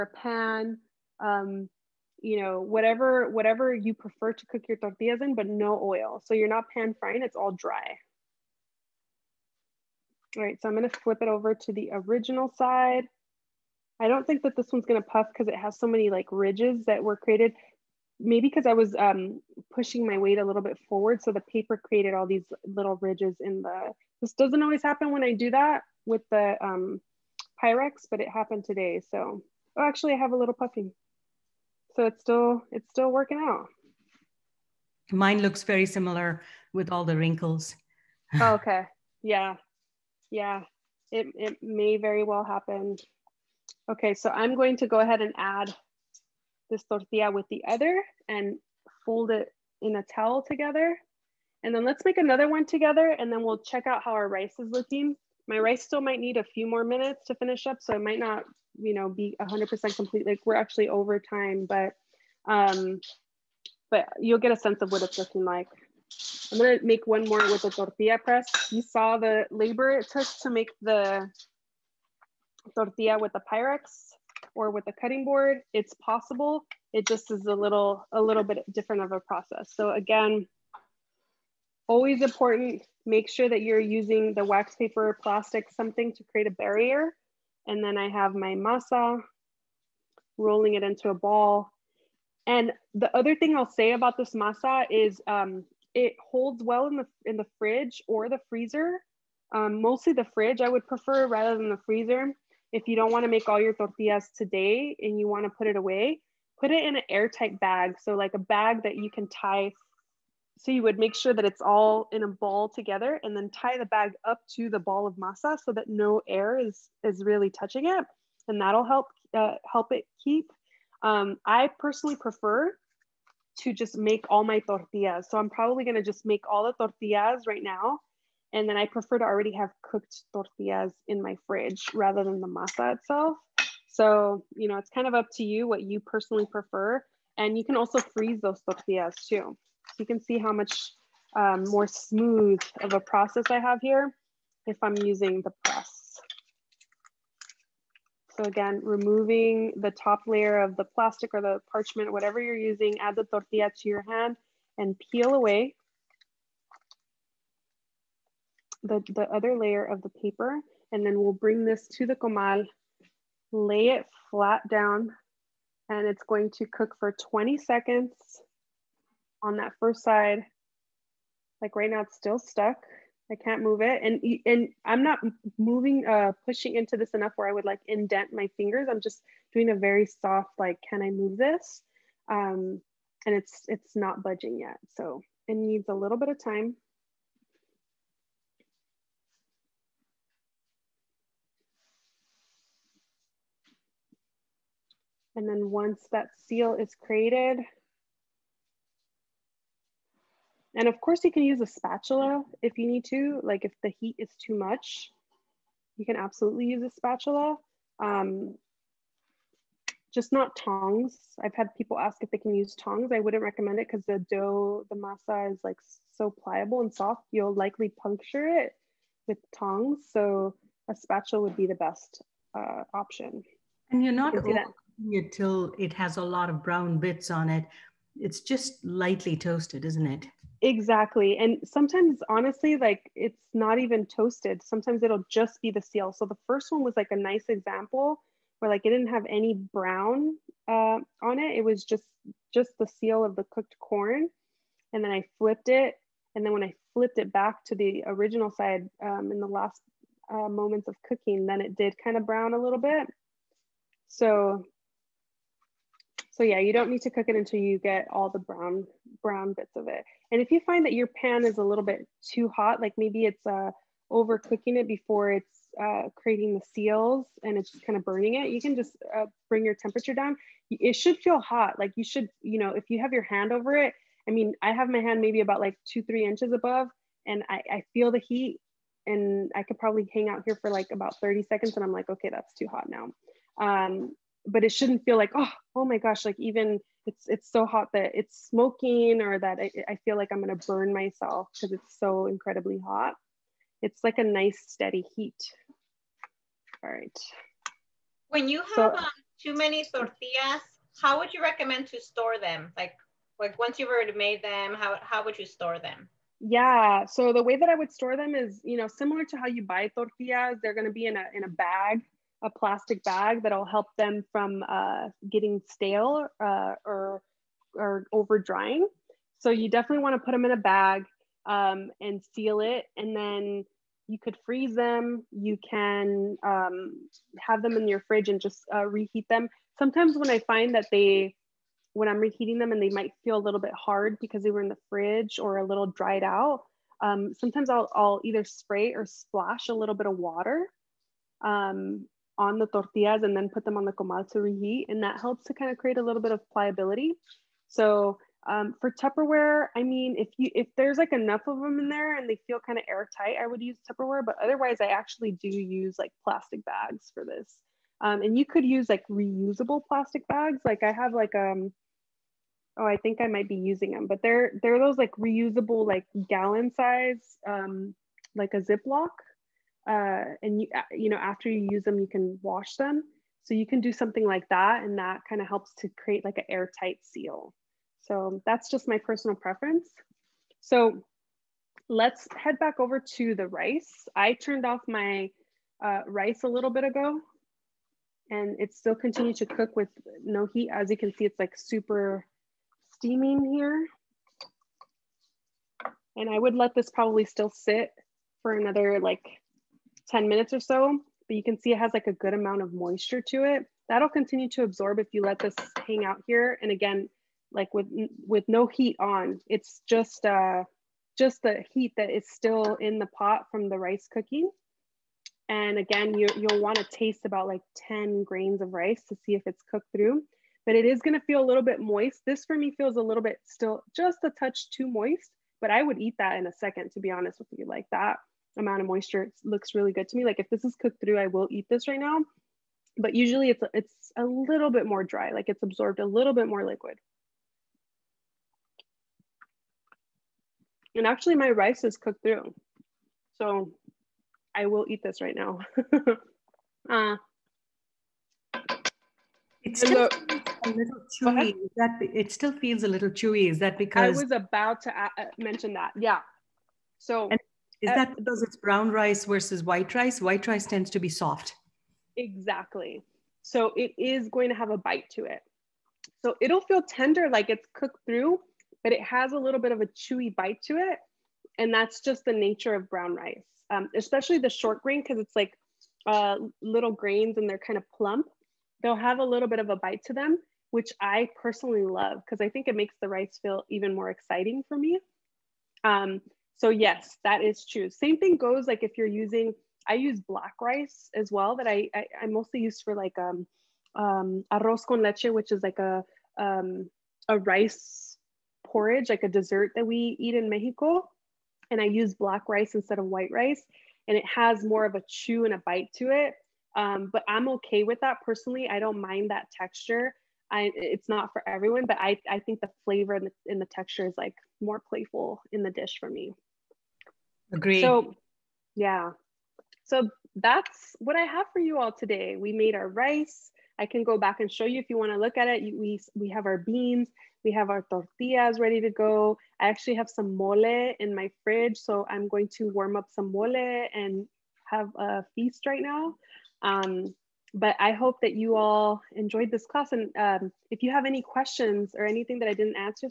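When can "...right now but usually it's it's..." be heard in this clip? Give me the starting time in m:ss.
7:11.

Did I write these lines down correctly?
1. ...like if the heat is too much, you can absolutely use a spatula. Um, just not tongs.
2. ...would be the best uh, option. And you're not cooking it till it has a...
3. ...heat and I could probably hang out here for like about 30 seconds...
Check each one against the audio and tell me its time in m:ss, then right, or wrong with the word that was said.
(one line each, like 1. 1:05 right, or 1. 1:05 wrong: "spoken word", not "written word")
1. 3:23 right
2. 3:41 right
3. 4:38 right.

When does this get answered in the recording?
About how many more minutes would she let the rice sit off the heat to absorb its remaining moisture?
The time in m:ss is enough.
6:40.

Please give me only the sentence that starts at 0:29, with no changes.
So, oh, actually I have a little puffing.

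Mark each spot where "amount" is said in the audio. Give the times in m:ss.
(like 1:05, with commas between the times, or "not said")
6:42, 7:08.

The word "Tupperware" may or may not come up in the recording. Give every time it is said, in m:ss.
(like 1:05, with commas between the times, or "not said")
5:48, 5:53.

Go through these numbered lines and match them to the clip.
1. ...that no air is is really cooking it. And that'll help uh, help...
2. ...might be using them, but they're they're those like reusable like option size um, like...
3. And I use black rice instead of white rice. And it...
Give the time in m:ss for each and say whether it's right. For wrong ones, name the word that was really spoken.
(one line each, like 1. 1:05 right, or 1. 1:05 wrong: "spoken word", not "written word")
1. 1:55 wrong: "touching", not "cooking"
2. 6:03 wrong: "gallon", not "option"
3. 8:21 right.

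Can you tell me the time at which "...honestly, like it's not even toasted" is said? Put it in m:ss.
3:52.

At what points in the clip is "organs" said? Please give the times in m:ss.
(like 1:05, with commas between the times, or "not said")
not said.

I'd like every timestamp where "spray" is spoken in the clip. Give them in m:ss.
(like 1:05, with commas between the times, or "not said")
5:38.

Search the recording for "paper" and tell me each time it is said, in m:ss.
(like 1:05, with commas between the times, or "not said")
0:21, 1:24, 2:40.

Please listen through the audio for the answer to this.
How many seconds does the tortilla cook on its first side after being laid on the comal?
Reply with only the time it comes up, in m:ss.
2:47.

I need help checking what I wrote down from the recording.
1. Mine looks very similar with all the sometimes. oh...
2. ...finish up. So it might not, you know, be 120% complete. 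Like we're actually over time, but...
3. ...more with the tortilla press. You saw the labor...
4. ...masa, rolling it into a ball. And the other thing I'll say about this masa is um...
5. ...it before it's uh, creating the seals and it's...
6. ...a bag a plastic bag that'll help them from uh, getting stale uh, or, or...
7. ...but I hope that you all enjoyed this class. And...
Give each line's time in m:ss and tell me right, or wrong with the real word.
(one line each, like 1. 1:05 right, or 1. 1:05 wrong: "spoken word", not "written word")
1. 0:35 wrong: "wrinkles", not "sometimes"
2. 0:57 wrong: "100", not "120"
3. 1:07 right
4. 1:28 right
5. 4:24 right
6. 5:11 right
7. 8:57 right.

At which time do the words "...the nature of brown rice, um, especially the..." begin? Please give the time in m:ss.
7:52.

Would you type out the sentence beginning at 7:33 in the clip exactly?
Is that because I was about to uh, mention that?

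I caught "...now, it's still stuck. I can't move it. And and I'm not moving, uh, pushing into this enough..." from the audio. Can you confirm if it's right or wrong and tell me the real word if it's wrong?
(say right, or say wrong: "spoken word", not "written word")
right.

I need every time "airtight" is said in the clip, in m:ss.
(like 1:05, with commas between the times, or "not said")
1:47, 5:52, 6:16.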